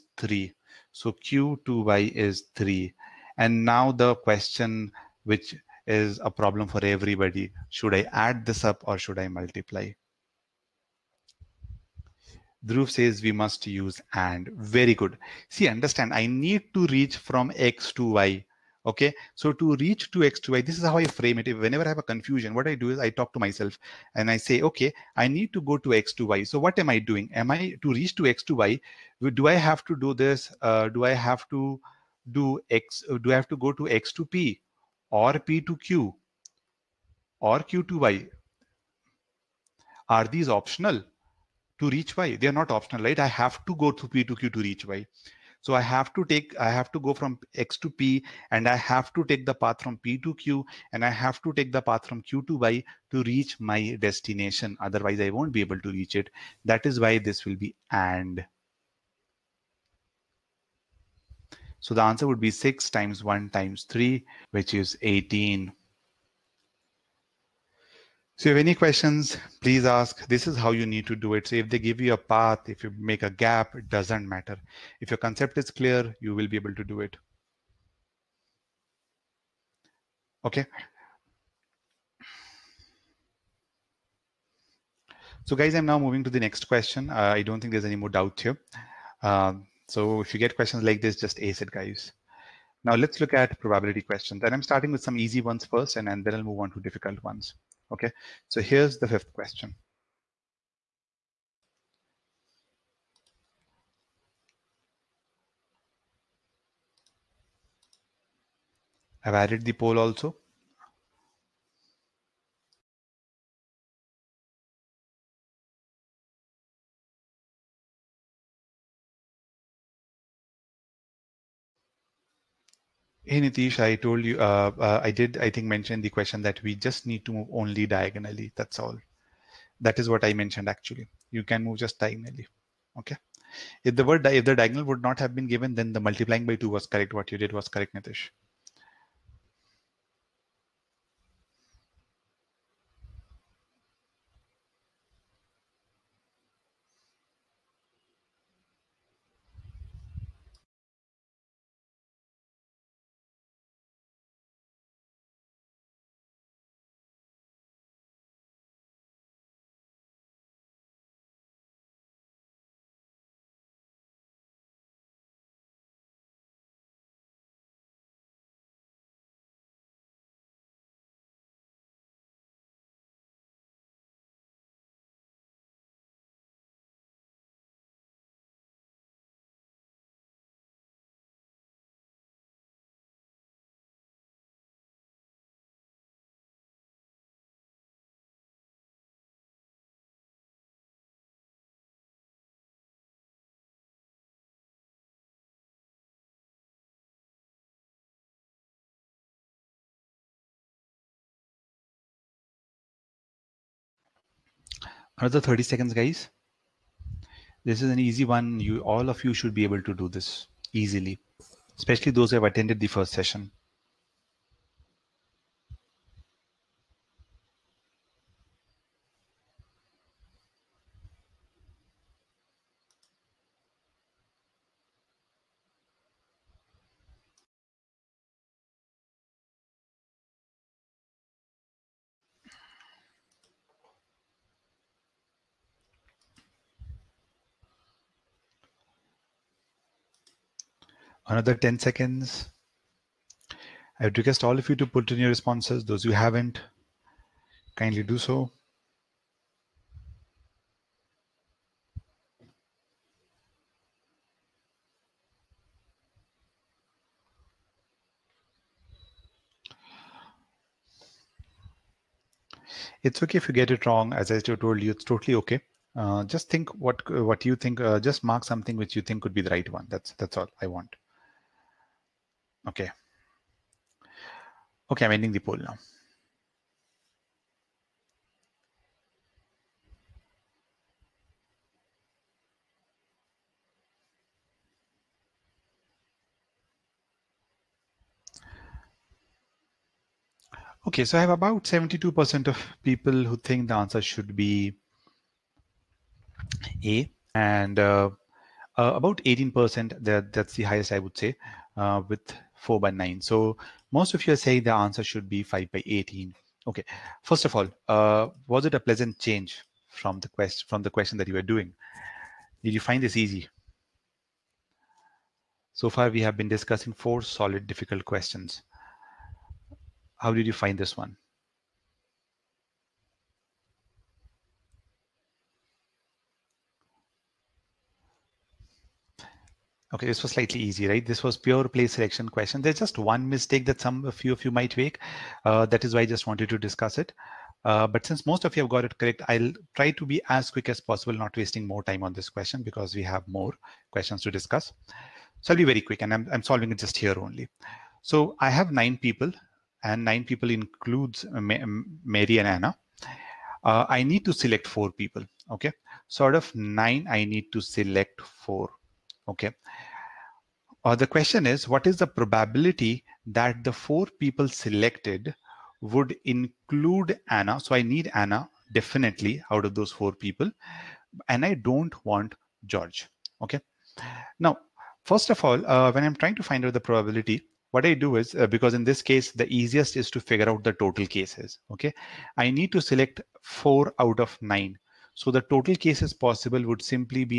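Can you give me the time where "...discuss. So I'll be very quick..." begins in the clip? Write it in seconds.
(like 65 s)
344 s.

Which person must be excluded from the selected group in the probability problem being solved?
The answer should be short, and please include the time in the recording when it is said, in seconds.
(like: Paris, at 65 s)
George, at 372 s.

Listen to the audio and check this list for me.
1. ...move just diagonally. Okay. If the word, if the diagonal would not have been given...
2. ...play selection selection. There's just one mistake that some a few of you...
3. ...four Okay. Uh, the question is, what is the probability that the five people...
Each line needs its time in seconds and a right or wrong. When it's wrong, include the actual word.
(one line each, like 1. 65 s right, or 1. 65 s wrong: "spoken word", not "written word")
1. 131 s right
2. 331 s wrong: "question", not "selection"
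3. 358 s wrong: "four", not "five".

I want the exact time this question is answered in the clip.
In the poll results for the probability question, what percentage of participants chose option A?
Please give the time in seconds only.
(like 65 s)
291 s.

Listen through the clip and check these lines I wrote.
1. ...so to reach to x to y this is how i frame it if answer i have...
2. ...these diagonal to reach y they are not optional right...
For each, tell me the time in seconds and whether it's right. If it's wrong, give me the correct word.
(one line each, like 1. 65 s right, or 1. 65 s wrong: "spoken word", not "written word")
1. 19 s wrong: "whenever", not "answer"
2. 40 s wrong: "optional", not "diagonal".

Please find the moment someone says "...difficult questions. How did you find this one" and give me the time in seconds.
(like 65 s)
317 s.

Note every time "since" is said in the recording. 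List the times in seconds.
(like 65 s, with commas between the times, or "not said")
338 s.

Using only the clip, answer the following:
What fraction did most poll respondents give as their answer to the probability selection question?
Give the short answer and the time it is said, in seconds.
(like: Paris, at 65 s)
5/18, at 305 s.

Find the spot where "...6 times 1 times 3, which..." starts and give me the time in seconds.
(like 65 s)
62 s.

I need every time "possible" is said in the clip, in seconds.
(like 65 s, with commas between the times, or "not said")
340 s, 386 s.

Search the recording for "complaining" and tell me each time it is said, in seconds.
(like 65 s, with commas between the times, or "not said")
not said.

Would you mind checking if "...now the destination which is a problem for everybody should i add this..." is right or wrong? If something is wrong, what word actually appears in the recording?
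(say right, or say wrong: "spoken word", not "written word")
wrong: "question", not "destination".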